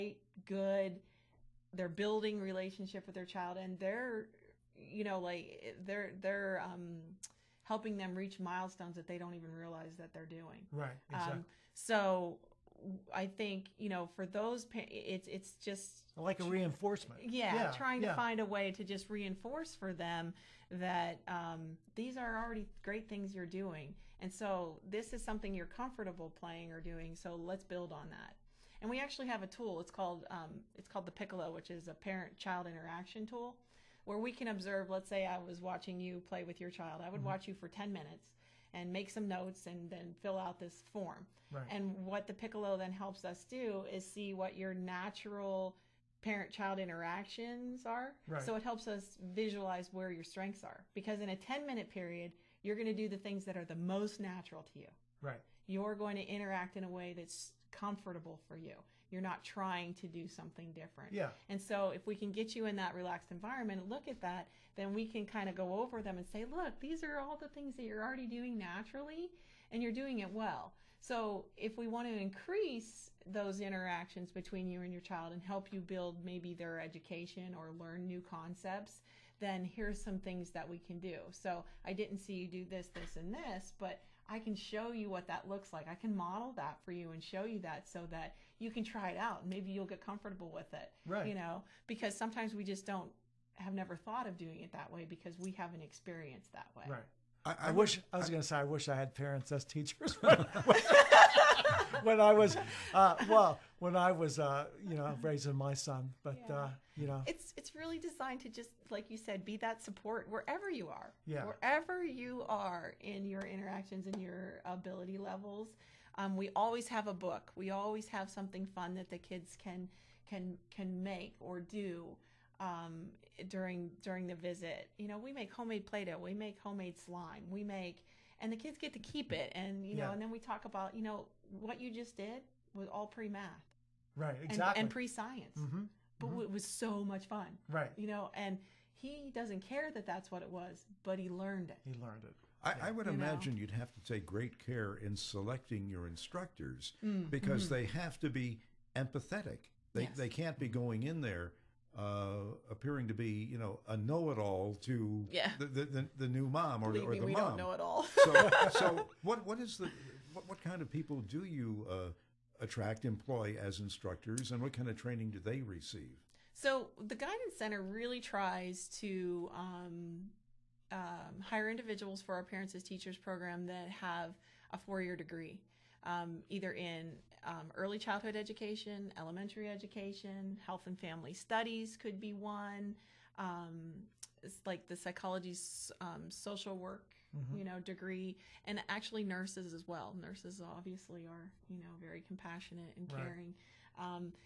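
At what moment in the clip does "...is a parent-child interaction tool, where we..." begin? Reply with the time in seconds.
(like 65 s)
31 s.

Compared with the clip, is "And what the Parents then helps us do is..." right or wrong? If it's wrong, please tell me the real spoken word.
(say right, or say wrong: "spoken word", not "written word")
wrong: "Piccolo", not "Parents".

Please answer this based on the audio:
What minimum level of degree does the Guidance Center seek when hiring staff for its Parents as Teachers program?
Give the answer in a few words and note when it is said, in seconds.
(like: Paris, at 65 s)
Four-year degree, at 174 s.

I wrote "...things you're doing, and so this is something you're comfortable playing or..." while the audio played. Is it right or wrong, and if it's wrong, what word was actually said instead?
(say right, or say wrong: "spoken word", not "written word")
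right.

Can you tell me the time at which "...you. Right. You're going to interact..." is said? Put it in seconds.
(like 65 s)
54 s.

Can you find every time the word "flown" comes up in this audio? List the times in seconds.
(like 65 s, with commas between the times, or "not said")
not said.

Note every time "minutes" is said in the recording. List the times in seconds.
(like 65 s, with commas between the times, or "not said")
37 s, 51 s.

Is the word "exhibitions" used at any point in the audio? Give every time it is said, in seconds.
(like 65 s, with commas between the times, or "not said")
not said.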